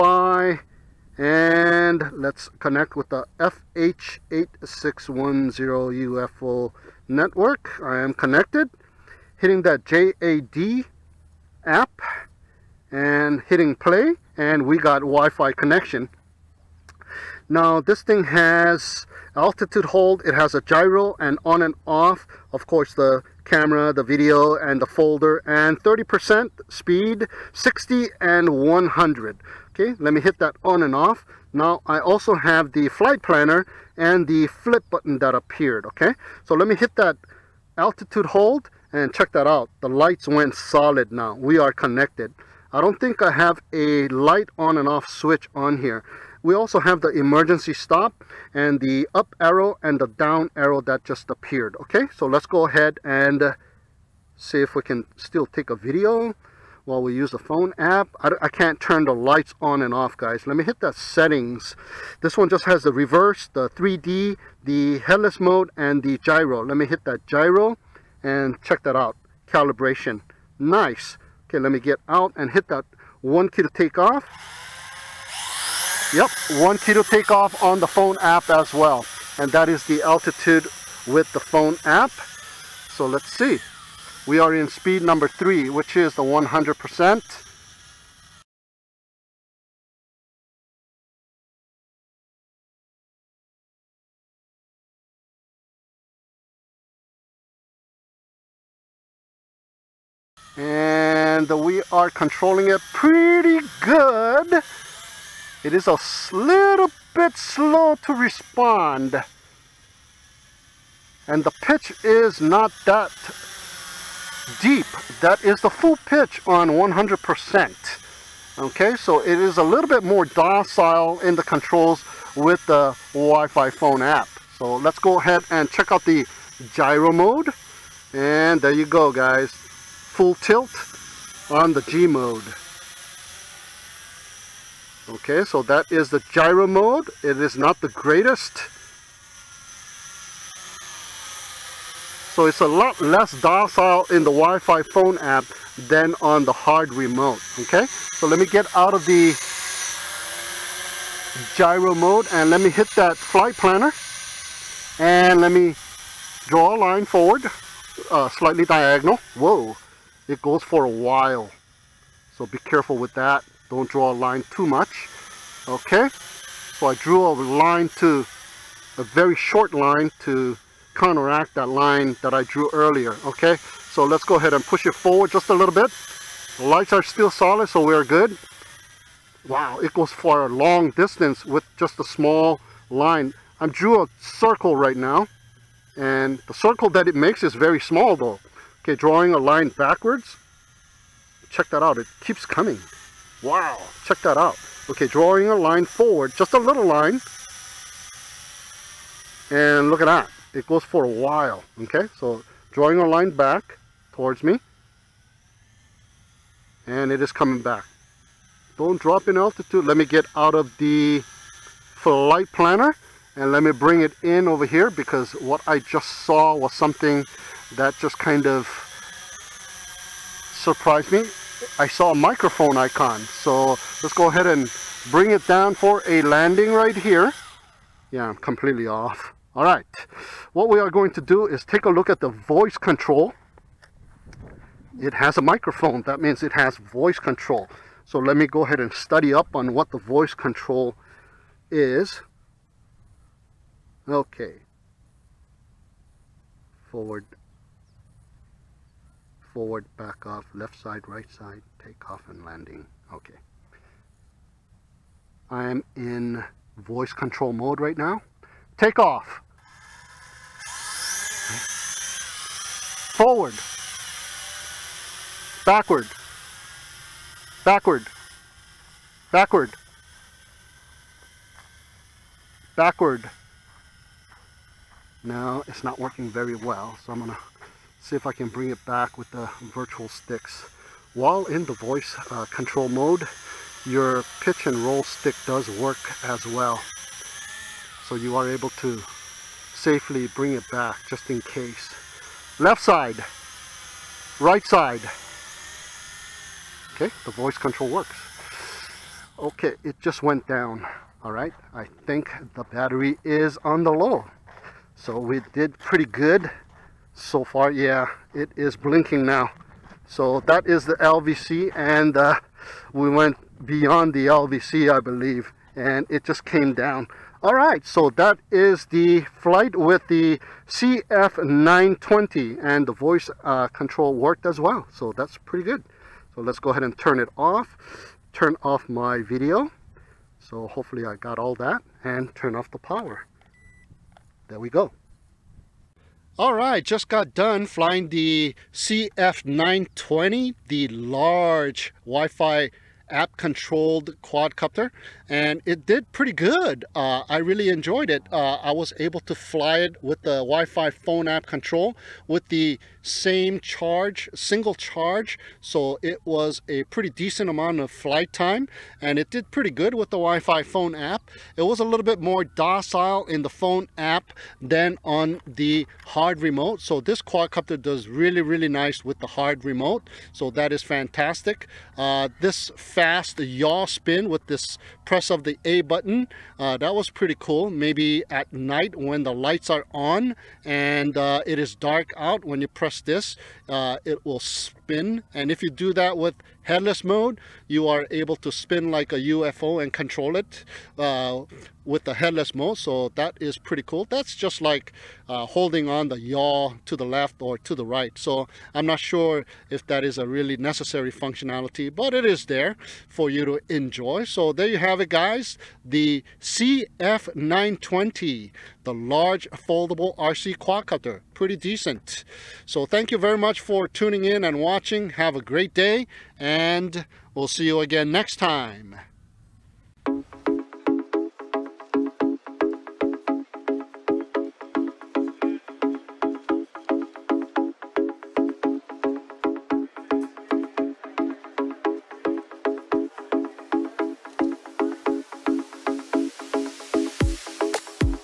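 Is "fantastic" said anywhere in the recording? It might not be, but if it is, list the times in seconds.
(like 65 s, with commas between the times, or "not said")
370 s.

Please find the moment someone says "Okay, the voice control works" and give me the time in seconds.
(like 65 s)
296 s.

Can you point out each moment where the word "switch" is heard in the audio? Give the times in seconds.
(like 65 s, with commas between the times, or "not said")
45 s.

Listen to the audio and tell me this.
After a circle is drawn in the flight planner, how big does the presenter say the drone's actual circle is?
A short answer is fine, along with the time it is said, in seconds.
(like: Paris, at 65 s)
very small, at 187 s.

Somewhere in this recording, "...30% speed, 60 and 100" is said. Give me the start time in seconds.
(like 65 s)
25 s.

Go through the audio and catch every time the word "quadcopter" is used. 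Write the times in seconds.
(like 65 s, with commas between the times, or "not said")
344 s, 367 s, 410 s.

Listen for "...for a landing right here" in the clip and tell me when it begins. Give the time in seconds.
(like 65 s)
225 s.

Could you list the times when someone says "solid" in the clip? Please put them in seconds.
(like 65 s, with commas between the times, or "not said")
40 s, 177 s.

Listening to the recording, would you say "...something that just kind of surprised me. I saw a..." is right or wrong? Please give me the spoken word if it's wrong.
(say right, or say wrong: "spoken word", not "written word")
right.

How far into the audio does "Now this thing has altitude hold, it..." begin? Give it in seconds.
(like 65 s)
17 s.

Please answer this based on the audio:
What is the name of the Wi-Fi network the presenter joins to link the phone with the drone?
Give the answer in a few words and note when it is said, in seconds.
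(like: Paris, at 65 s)
FH8610 UFO, at 3 s.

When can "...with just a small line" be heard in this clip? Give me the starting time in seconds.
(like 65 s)
181 s.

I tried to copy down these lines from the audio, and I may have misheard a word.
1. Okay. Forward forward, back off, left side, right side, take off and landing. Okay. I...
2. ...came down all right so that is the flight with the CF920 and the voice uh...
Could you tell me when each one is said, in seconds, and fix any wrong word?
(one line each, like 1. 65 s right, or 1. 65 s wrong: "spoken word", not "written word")
1. 244 s right
2. 316 s right.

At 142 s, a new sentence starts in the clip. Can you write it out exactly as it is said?
So it's a lot less docile in the Wi-Fi phone app than on the hard remote, okay?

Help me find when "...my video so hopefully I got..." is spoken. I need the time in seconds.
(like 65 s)
328 s.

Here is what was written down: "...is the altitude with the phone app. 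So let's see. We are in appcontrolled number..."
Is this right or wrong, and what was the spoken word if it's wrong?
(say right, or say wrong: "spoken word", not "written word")
wrong: "speed", not "appcontrolled".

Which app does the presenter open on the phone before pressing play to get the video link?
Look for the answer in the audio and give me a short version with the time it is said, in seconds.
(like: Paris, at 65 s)
JAD, at 9 s.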